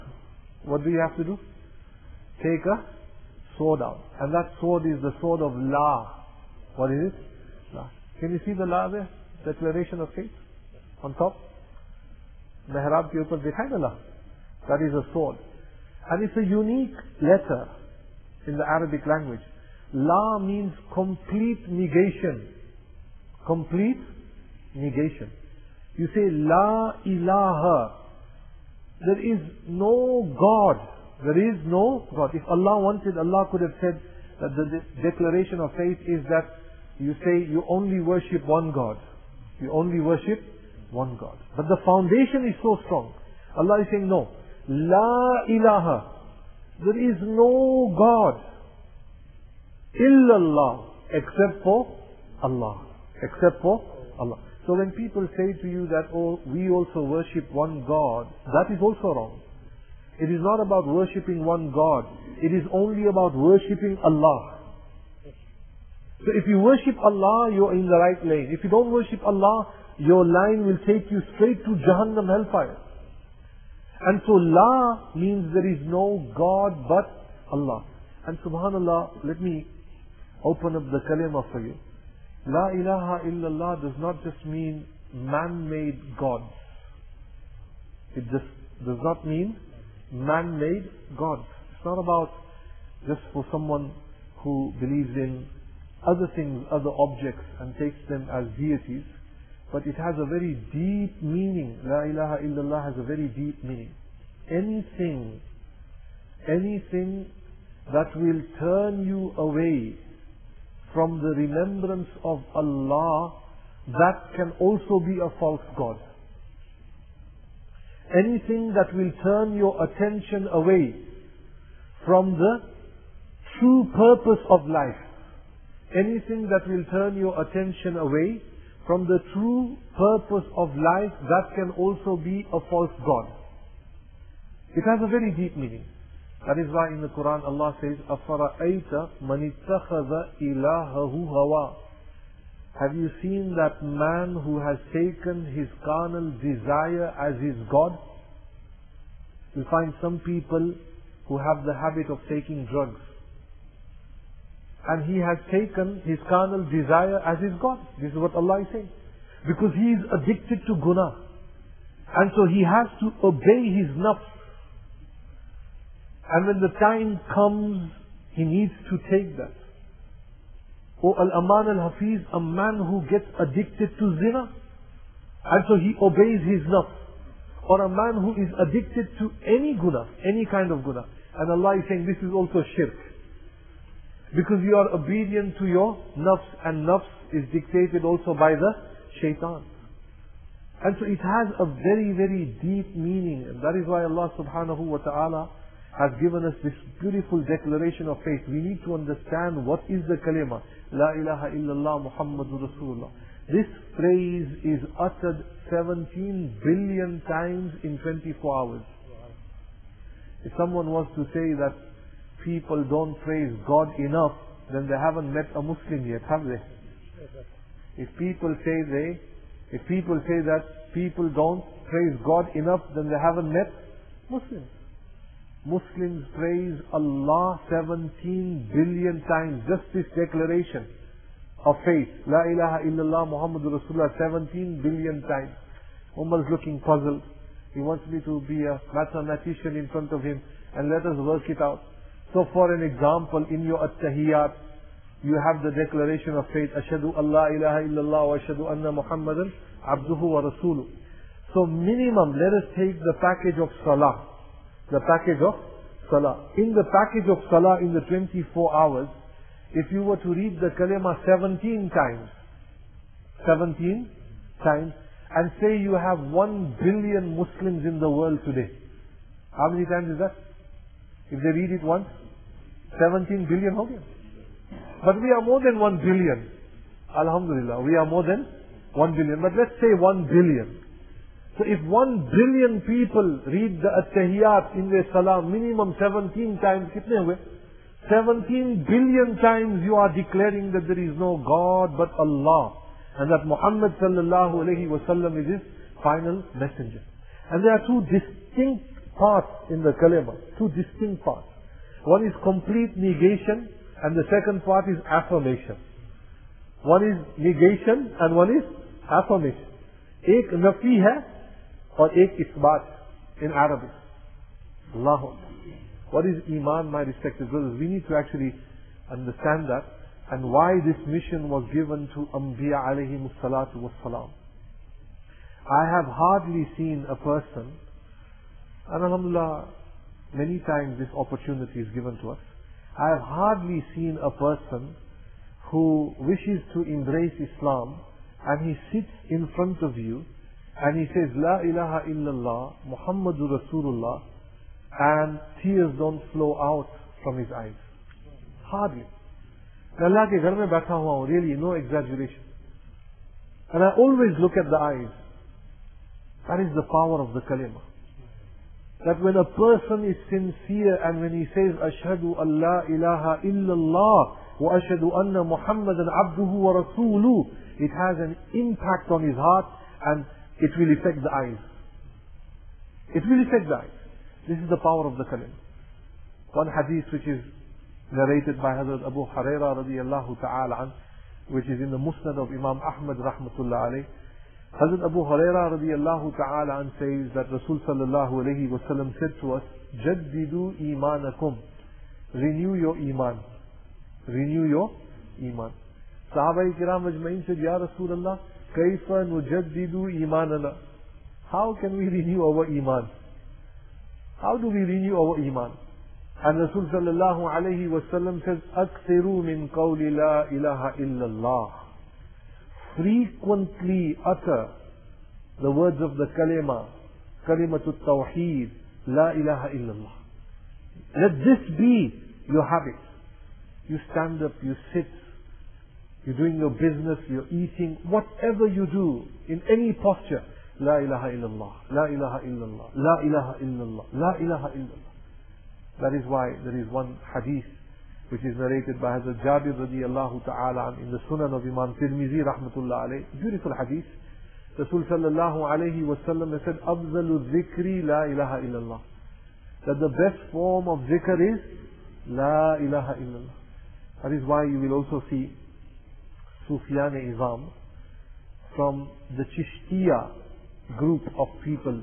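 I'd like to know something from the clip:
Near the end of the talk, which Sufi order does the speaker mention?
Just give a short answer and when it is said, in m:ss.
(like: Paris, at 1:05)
Chishtiya, at 7:39.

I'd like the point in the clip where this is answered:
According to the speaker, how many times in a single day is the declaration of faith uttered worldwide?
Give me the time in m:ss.
3:25.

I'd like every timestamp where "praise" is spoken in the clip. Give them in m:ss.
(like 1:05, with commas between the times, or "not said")
3:33, 3:41, 3:46.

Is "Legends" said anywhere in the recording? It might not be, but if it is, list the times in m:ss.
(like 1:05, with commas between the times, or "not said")
not said.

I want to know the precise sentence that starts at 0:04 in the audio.
And that sword is the sword of La.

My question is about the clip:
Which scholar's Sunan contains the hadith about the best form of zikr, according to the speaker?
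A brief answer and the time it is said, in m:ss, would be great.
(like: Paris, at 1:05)
Imam Tirmizi, at 7:21.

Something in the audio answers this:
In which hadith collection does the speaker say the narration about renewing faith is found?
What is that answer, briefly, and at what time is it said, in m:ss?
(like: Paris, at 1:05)
Musnad of Imam Ahmad, at 6:21.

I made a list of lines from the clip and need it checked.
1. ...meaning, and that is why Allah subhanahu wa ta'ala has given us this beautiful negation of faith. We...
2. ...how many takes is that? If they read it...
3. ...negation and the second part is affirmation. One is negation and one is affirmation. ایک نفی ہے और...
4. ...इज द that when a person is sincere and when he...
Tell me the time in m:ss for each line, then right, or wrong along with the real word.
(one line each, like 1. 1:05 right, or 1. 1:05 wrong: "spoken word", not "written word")
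1. 3:12 wrong: "declaration", not "negation"
2. 4:29 wrong: "times", not "takes"
3. 5:02 right
4. 5:56 right.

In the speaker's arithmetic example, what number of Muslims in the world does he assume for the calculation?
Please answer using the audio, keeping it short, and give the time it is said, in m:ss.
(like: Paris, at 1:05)
1 billion, at 4:25.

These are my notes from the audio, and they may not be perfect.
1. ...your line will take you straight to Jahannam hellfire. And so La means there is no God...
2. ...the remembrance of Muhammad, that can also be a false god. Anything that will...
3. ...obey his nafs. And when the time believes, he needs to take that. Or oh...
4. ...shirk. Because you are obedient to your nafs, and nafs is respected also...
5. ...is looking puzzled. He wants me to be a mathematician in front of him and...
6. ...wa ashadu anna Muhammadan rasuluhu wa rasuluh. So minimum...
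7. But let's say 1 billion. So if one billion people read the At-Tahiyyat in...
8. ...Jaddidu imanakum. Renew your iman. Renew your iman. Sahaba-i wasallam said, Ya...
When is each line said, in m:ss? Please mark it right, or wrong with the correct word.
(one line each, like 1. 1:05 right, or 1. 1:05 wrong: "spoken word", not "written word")
1. 1:09 right
2. 1:51 wrong: "Allah", not "Muhammad"
3. 2:43 wrong: "comes", not "believes"
4. 3:02 wrong: "dictated", not "respected"
5. 3:56 right
6. 4:08 wrong: "abduhu", not "rasuluhu"
7. 4:39 right
8. 6:30 wrong: "kiram", not "wasallam".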